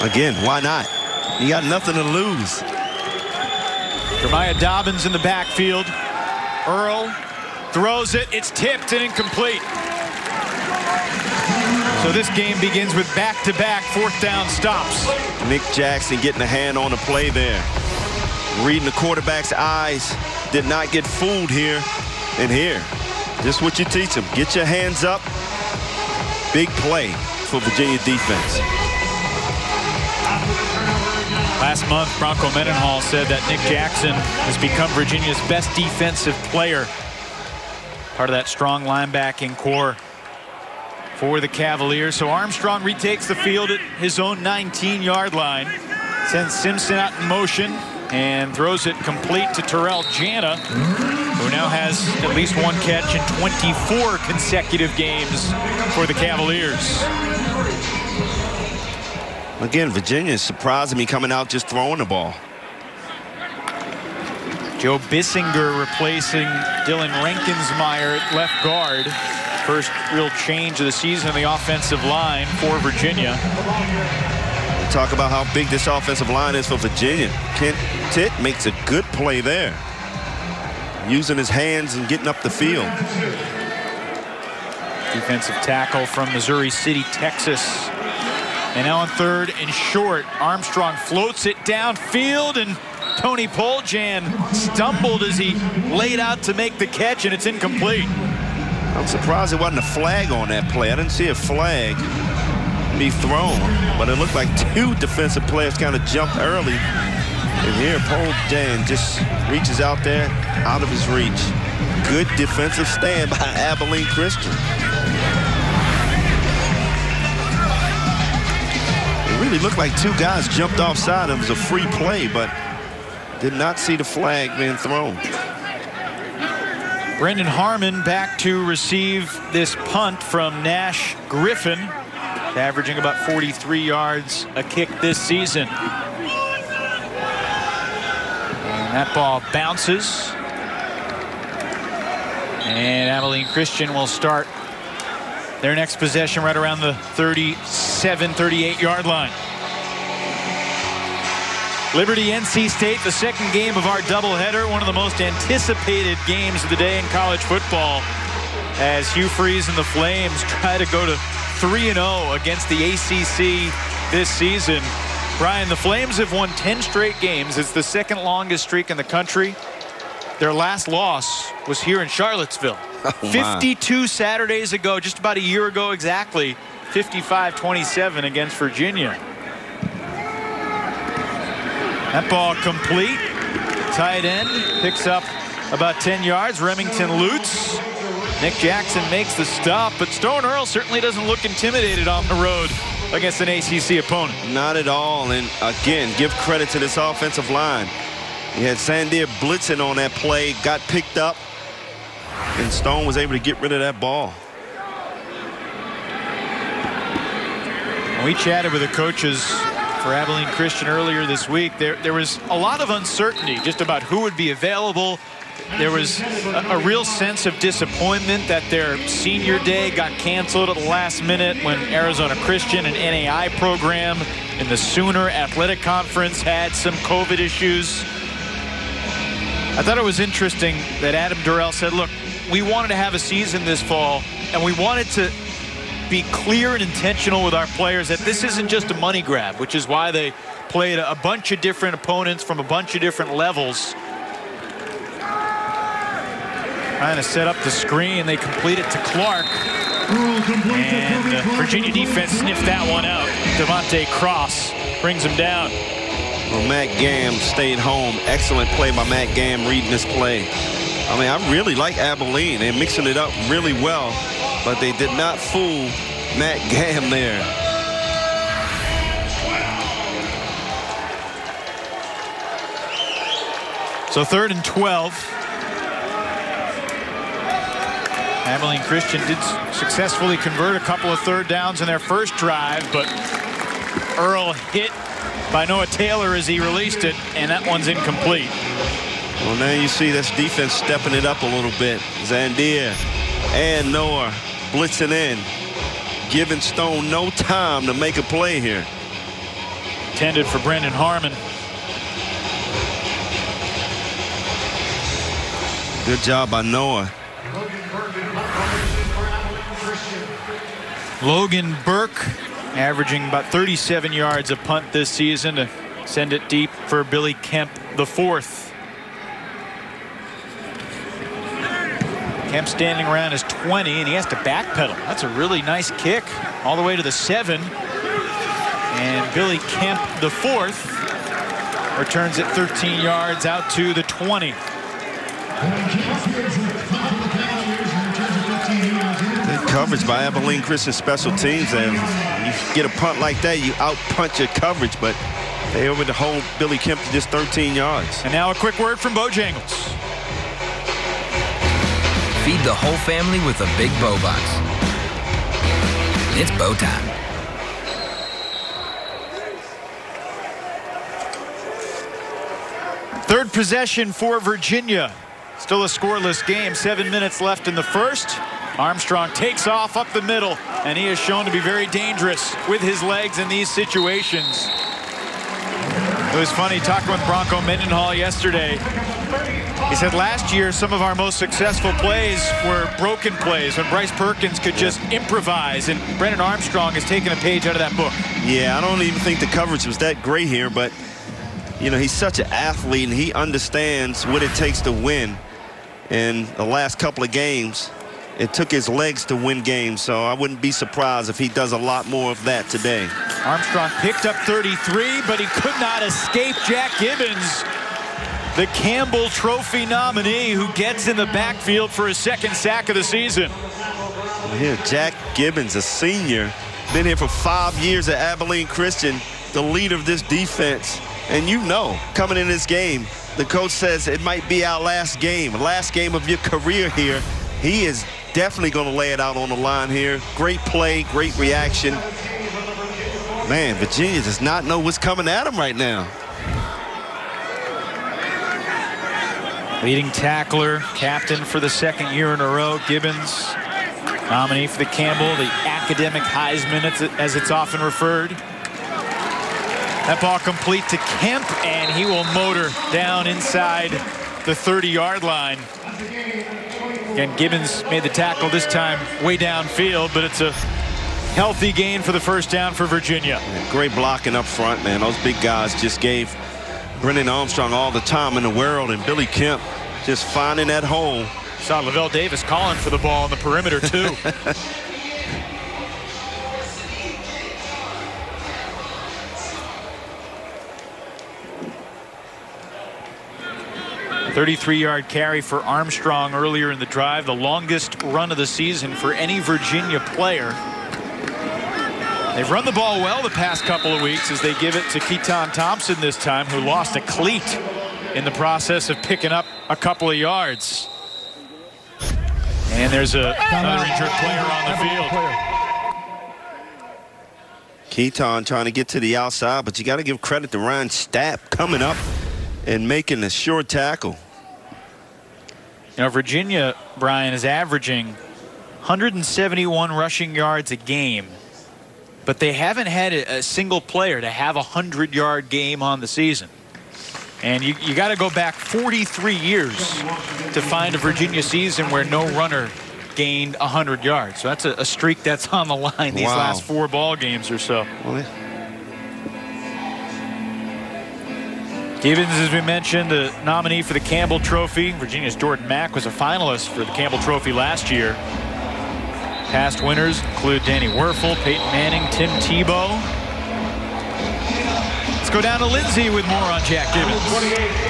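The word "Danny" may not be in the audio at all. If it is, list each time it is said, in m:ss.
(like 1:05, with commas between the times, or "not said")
9:10.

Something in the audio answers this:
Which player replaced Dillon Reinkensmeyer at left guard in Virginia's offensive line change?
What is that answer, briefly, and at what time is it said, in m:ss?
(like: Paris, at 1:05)
Joe Bissinger, at 1:04.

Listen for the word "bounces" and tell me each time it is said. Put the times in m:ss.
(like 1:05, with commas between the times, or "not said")
2:19.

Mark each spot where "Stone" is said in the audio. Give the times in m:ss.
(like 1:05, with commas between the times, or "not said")
3:10, 3:22, 4:56.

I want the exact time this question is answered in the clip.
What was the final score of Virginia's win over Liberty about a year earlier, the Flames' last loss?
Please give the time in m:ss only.
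2:56.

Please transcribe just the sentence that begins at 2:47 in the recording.
It's the second longest streak in the country.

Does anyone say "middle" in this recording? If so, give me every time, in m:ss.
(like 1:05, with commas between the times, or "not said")
6:10.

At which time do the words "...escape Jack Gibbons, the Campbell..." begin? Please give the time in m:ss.
6:46.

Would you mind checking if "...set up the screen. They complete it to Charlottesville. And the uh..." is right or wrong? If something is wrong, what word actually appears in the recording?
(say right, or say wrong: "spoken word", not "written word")
wrong: "Clark", not "Charlottesville".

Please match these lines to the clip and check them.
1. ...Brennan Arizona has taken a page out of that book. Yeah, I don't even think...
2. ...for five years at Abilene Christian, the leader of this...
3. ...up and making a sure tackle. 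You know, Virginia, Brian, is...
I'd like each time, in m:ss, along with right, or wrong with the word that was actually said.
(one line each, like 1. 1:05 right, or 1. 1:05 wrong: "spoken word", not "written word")
1. 6:26 wrong: "Armstrong", not "Arizona"
2. 6:57 right
3. 8:31 right.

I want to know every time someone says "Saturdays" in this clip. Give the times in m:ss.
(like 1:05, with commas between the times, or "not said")
2:54.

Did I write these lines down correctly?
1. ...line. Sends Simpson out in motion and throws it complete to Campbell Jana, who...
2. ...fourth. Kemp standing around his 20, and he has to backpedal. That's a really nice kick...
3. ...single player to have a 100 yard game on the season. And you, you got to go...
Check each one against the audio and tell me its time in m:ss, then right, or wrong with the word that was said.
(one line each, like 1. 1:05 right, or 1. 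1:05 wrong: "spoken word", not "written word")
1. 0:45 wrong: "Terrell", not "Campbell"
2. 5:18 right
3. 8:43 right.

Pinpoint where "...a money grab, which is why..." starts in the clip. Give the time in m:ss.
3:58.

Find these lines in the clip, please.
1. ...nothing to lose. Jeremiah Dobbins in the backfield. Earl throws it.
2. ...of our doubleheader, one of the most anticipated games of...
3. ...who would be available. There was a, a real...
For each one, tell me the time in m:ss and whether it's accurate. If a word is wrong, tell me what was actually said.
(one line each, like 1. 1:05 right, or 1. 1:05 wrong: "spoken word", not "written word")
1. 0:01 right
2. 2:33 right
3. 3:34 right.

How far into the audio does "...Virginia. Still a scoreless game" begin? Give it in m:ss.
6:04.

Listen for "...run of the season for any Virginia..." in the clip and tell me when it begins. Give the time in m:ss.
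8:08.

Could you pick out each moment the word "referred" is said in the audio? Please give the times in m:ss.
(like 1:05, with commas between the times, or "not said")
7:27.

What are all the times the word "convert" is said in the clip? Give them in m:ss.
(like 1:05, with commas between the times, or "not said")
4:40.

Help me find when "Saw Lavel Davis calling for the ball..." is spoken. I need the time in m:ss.
7:51.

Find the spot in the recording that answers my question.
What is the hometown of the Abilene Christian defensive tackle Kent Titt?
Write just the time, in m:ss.
1:26.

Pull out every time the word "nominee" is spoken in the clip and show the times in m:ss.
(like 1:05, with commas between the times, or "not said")
6:49, 7:24, 9:03.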